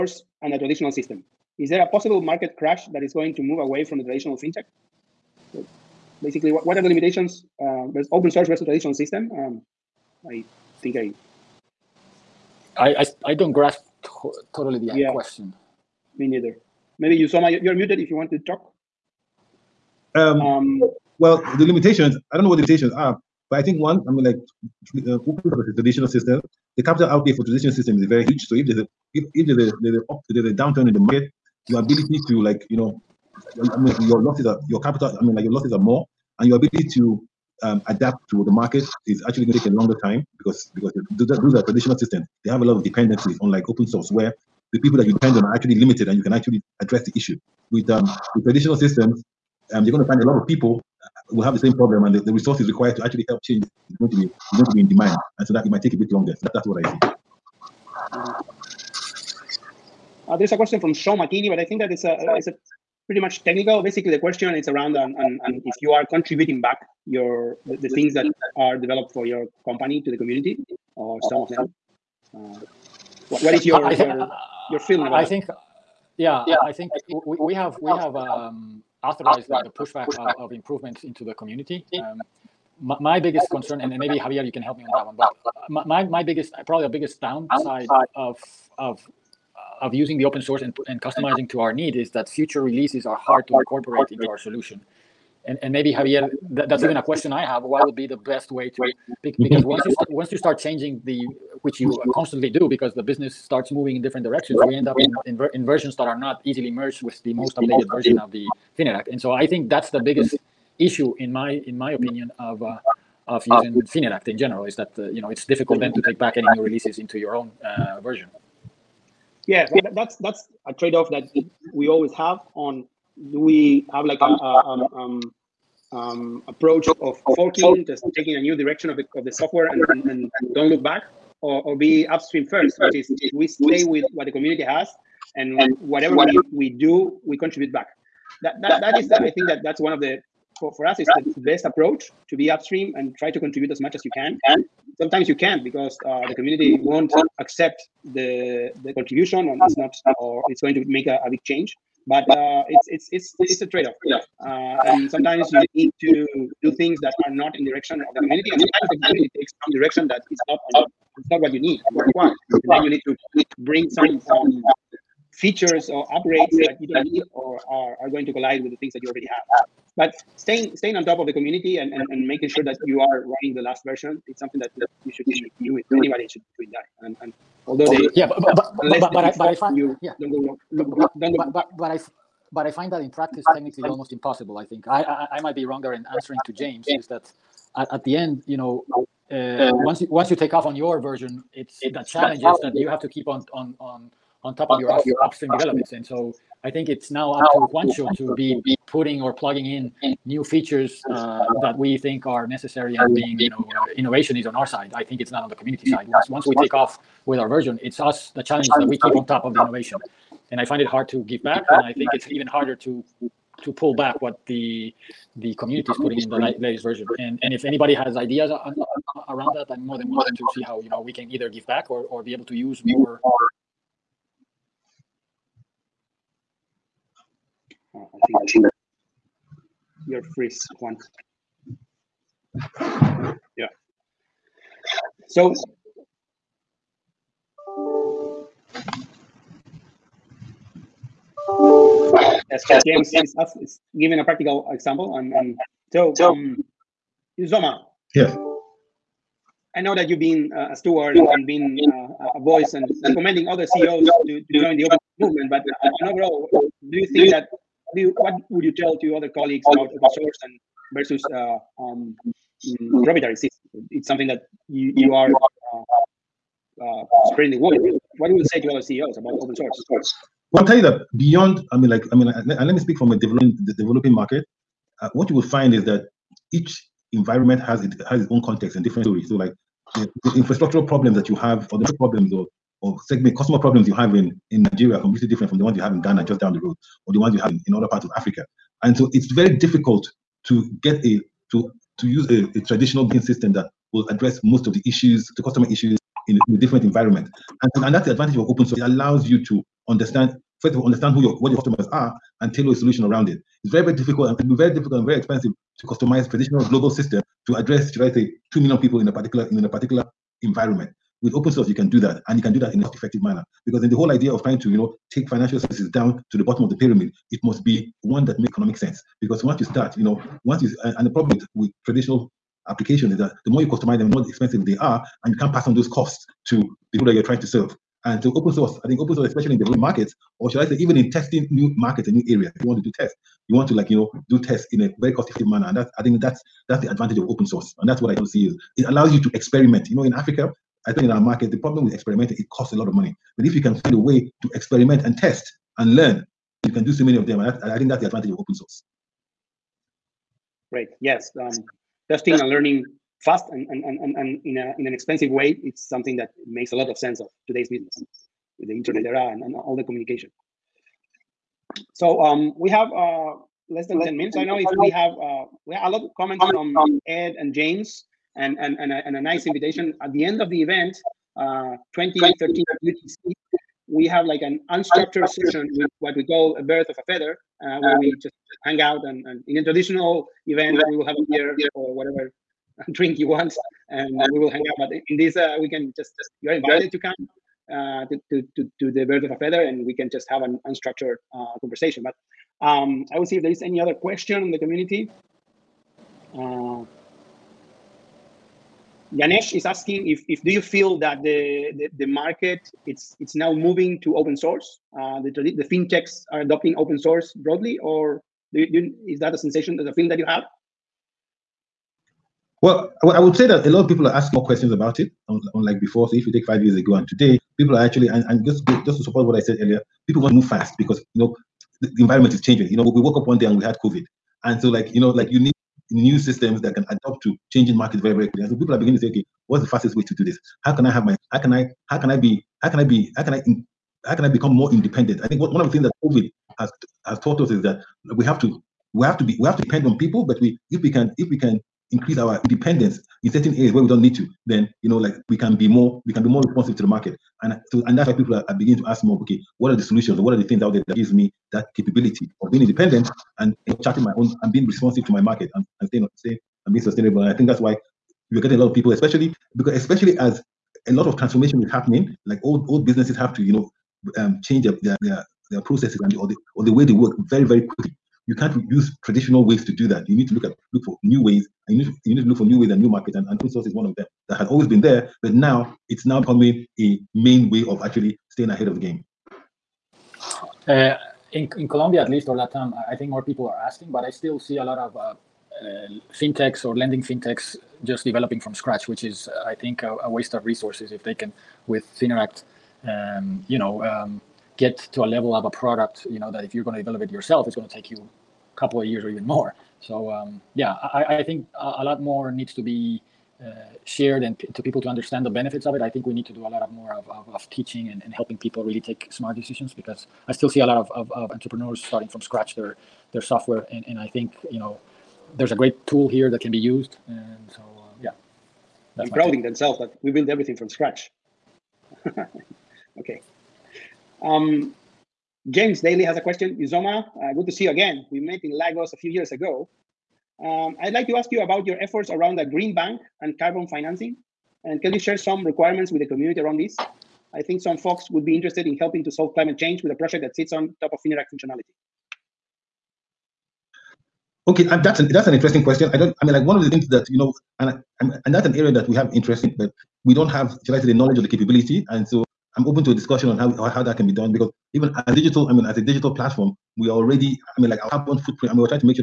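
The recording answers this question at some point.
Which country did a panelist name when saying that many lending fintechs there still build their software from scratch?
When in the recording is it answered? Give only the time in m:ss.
8:01.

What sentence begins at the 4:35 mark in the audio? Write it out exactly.
Uh, what you will find is that each environment has it has its own context and different stories.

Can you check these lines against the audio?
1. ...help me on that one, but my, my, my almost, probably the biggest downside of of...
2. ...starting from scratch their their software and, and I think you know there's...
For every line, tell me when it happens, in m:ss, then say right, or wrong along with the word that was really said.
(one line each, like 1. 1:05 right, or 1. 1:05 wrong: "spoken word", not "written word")
1. 1:24 wrong: "biggest", not "almost"
2. 8:31 right.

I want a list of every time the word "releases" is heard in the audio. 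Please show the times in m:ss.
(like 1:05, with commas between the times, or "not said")
1:32, 1:56.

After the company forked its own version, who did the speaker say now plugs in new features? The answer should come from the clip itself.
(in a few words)
Juancho.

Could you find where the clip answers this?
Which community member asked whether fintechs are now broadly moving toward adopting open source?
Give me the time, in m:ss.
6:39.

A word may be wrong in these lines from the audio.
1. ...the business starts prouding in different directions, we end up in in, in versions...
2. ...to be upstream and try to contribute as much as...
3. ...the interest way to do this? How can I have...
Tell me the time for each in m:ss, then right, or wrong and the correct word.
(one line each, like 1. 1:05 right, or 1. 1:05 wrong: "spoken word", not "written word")
1. 1:42 wrong: "moving", not "prouding"
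2. 2:22 right
3. 7:09 wrong: "fastest", not "interest".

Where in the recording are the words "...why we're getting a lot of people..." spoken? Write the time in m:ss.
7:37.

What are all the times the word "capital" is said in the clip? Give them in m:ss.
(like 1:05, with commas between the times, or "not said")
0:26, 0:34.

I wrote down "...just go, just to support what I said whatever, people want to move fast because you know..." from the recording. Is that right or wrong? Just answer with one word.
wrong.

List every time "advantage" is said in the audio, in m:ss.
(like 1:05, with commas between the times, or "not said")
4:58, 5:36, 5:48.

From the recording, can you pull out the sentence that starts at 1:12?
Uh, what, what is your I, your, your feeling about I that?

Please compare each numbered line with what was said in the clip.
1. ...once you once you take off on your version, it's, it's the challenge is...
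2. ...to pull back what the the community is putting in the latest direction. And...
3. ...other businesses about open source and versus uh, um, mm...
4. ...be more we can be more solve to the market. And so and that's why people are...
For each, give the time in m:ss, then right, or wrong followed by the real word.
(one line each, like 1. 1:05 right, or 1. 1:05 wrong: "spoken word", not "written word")
1. 3:09 right
2. 3:33 wrong: "version", not "direction"
3. 4:19 wrong: "colleagues", not "businesses"
4. 7:25 wrong: "responsive", not "solve".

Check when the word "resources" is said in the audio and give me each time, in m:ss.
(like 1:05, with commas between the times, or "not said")
0:52, 8:10.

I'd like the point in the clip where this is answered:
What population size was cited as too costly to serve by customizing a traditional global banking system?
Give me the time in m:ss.
5:08.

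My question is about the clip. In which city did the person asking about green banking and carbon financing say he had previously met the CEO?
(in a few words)
Lagos.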